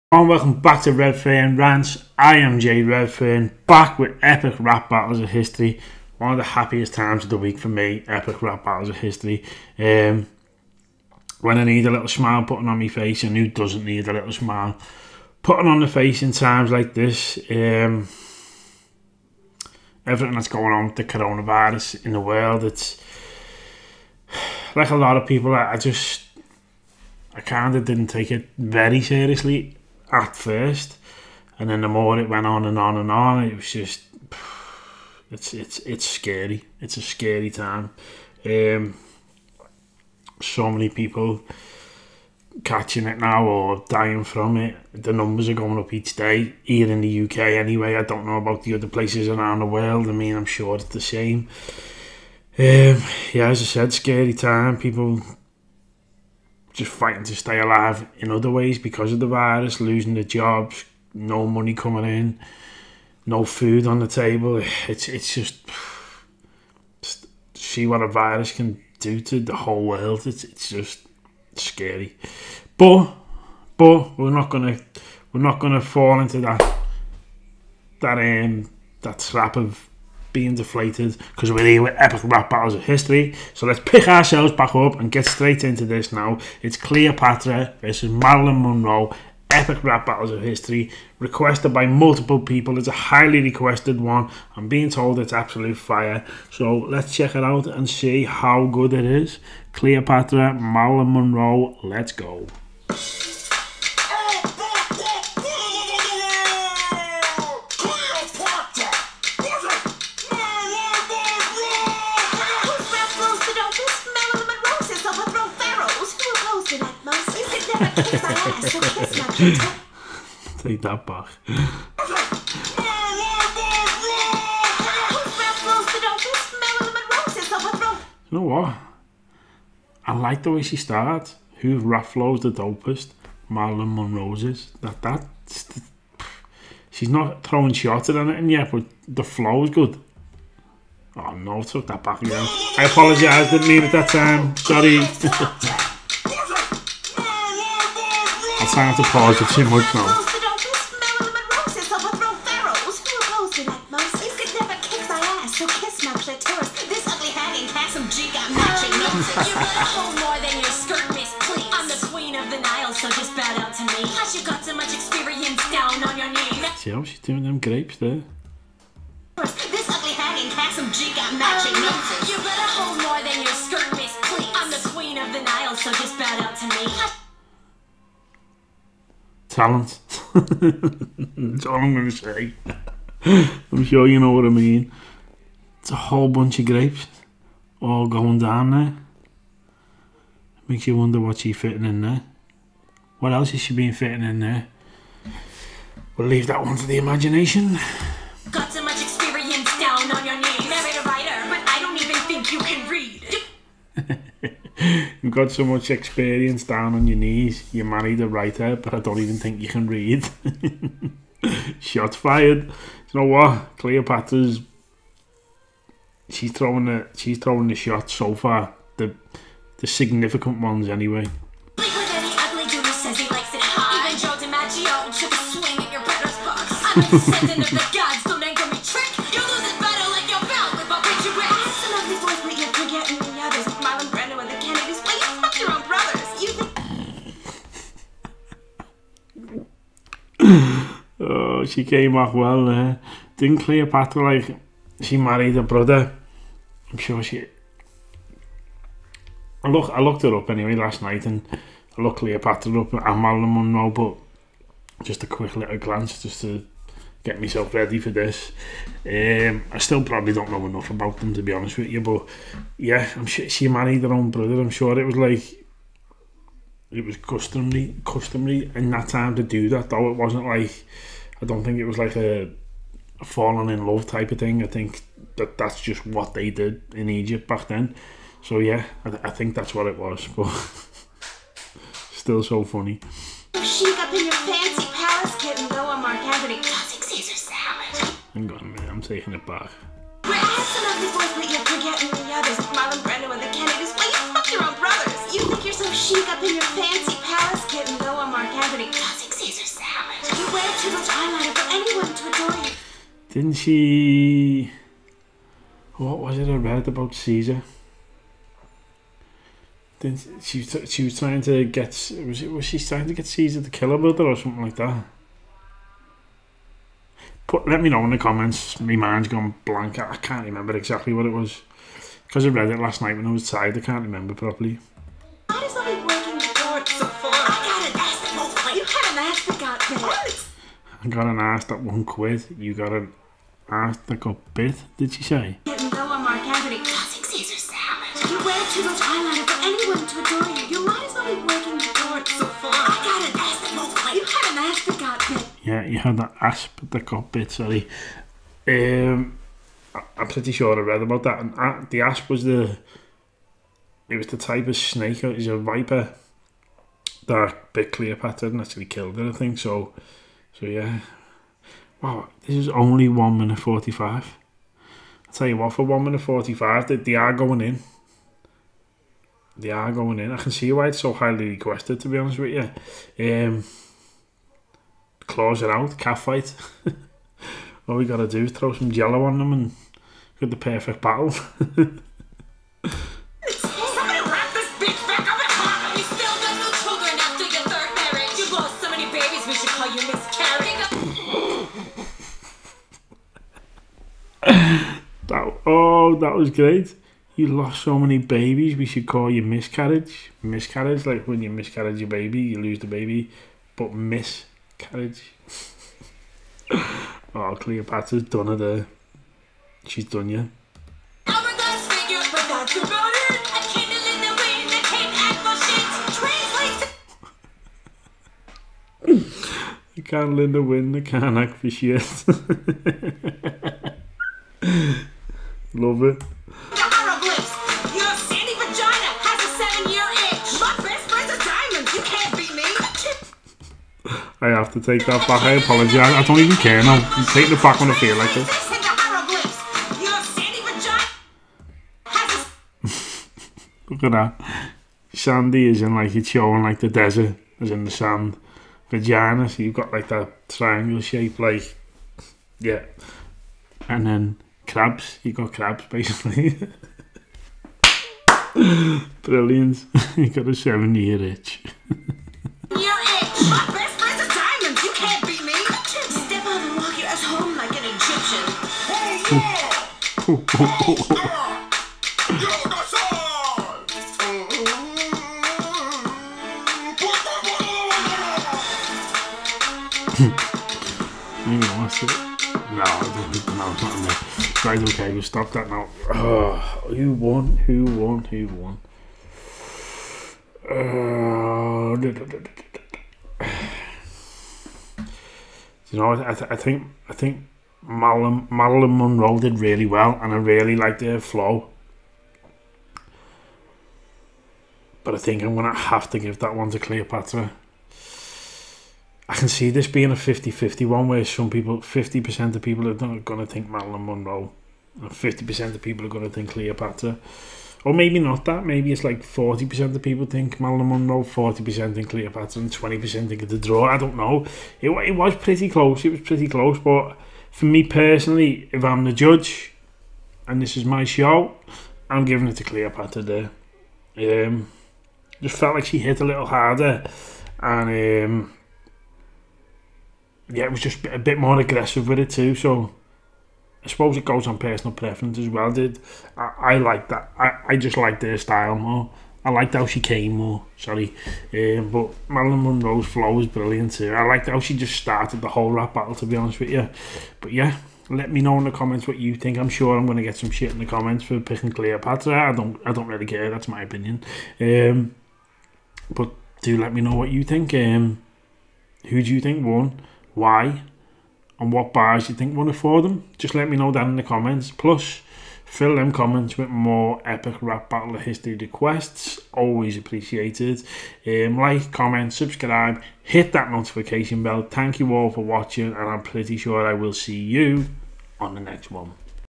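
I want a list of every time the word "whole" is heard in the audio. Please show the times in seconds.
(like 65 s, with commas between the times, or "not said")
69 s, 185 s, 555 s.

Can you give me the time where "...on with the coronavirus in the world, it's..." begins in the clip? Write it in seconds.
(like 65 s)
20 s.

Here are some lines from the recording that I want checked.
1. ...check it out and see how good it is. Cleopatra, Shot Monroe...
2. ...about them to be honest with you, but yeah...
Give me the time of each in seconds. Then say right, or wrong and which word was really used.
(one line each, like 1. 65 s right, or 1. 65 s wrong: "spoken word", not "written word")
1. 97 s wrong: "Marilyn", not "Shot"
2. 260 s right.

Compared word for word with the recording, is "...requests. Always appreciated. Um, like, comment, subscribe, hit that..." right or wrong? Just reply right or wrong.
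right.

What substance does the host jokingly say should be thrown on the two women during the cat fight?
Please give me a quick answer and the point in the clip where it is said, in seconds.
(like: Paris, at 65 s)
jello, at 378 s.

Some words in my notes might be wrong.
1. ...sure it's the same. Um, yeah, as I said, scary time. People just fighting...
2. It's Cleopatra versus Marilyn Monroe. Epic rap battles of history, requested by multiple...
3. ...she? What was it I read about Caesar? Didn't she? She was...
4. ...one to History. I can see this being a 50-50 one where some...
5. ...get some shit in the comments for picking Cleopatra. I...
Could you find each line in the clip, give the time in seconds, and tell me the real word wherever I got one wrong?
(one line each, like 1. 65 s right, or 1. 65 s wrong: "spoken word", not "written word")
1. 50 s right
2. 86 s right
3. 303 s right
4. 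506 s wrong: "Cleopatra", not "History"
5. 560 s right.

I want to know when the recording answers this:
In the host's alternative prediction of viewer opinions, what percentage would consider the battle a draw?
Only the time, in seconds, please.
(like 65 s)
522 s.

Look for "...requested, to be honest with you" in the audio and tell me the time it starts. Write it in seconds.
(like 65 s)
371 s.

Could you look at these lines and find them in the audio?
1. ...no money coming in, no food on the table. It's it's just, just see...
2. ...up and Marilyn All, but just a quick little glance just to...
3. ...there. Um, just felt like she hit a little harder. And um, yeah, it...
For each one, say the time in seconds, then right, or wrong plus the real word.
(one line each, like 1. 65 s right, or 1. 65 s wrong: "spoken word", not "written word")
1. 61 s right
2. 252 s wrong: "Monroe", not "All"
3. 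533 s right.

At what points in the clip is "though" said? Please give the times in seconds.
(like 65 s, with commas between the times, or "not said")
269 s.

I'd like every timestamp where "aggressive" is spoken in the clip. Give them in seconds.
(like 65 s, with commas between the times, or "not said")
541 s.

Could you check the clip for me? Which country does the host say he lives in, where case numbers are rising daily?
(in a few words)
UK.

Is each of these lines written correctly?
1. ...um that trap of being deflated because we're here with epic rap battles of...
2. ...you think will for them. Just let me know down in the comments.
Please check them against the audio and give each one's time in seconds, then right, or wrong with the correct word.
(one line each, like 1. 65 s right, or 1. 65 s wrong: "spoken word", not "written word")
1. 78 s right
2. 572 s right.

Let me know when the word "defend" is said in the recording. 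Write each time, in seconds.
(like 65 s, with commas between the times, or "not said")
not said.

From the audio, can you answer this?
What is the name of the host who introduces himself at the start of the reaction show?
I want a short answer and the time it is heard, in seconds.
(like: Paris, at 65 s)
Jay Redfern, at 2 s.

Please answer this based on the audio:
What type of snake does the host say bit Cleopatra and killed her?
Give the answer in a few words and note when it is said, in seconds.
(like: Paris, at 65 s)
viper, at 355 s.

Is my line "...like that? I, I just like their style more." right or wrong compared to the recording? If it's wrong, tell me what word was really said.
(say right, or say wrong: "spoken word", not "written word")
right.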